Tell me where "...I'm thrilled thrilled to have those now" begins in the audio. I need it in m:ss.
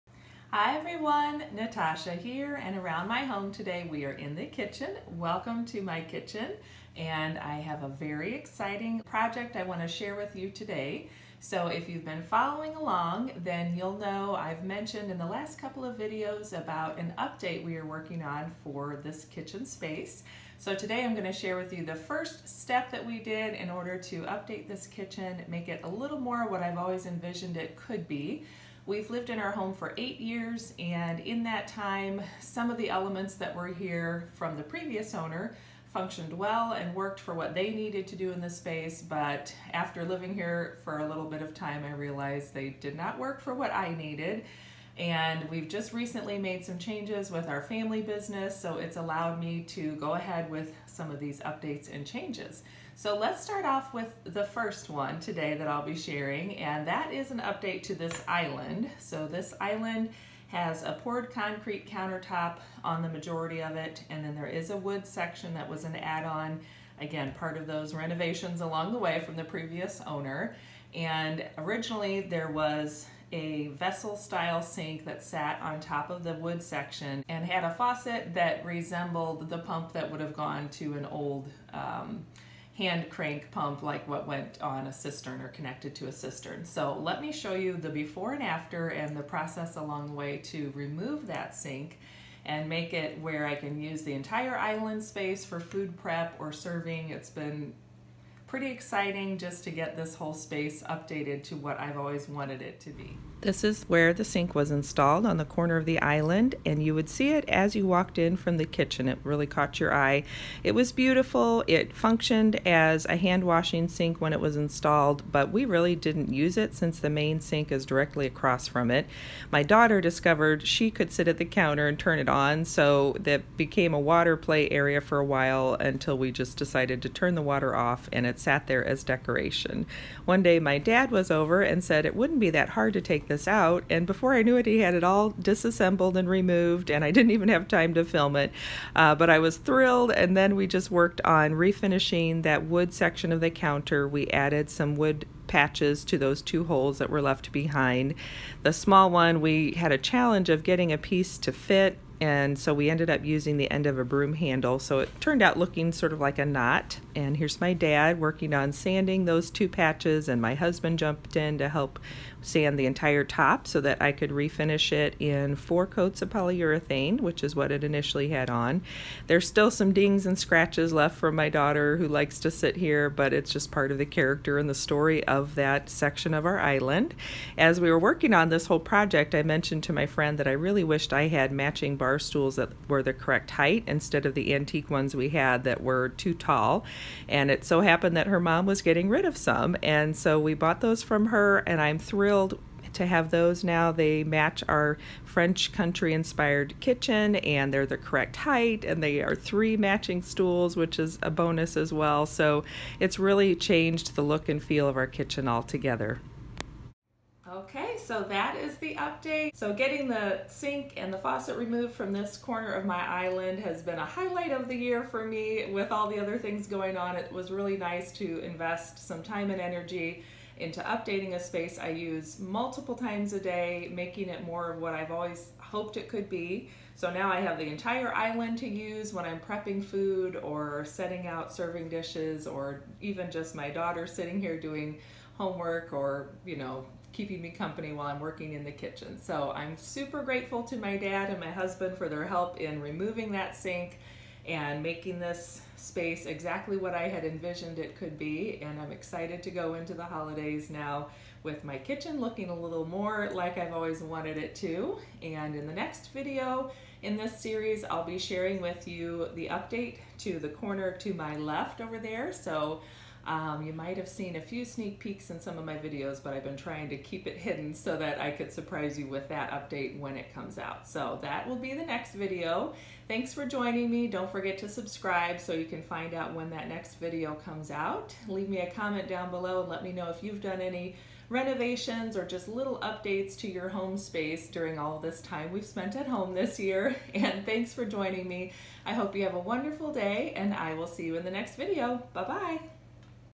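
3:11.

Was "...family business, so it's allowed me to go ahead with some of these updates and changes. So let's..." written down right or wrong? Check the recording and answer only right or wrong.
right.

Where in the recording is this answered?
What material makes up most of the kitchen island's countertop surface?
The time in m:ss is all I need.
1:01.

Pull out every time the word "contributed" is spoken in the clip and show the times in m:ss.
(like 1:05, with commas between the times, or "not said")
not said.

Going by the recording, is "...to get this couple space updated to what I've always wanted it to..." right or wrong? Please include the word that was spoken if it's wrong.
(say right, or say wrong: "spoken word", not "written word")
wrong: "whole", not "couple".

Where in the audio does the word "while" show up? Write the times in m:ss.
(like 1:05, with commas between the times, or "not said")
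2:05, 3:57.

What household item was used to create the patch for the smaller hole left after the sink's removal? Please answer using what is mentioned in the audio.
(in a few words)
Broom handle.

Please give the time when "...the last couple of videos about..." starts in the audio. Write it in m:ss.
0:15.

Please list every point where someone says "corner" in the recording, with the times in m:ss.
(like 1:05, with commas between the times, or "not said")
1:45, 3:32, 4:20.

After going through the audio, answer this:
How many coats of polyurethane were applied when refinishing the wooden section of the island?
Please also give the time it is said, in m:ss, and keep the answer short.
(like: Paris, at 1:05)
4, at 2:45.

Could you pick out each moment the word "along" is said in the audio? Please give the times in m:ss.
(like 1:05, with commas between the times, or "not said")
0:12, 1:08, 1:29.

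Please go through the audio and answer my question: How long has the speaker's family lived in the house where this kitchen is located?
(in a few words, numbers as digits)
8 years.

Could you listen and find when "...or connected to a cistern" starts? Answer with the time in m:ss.
1:25.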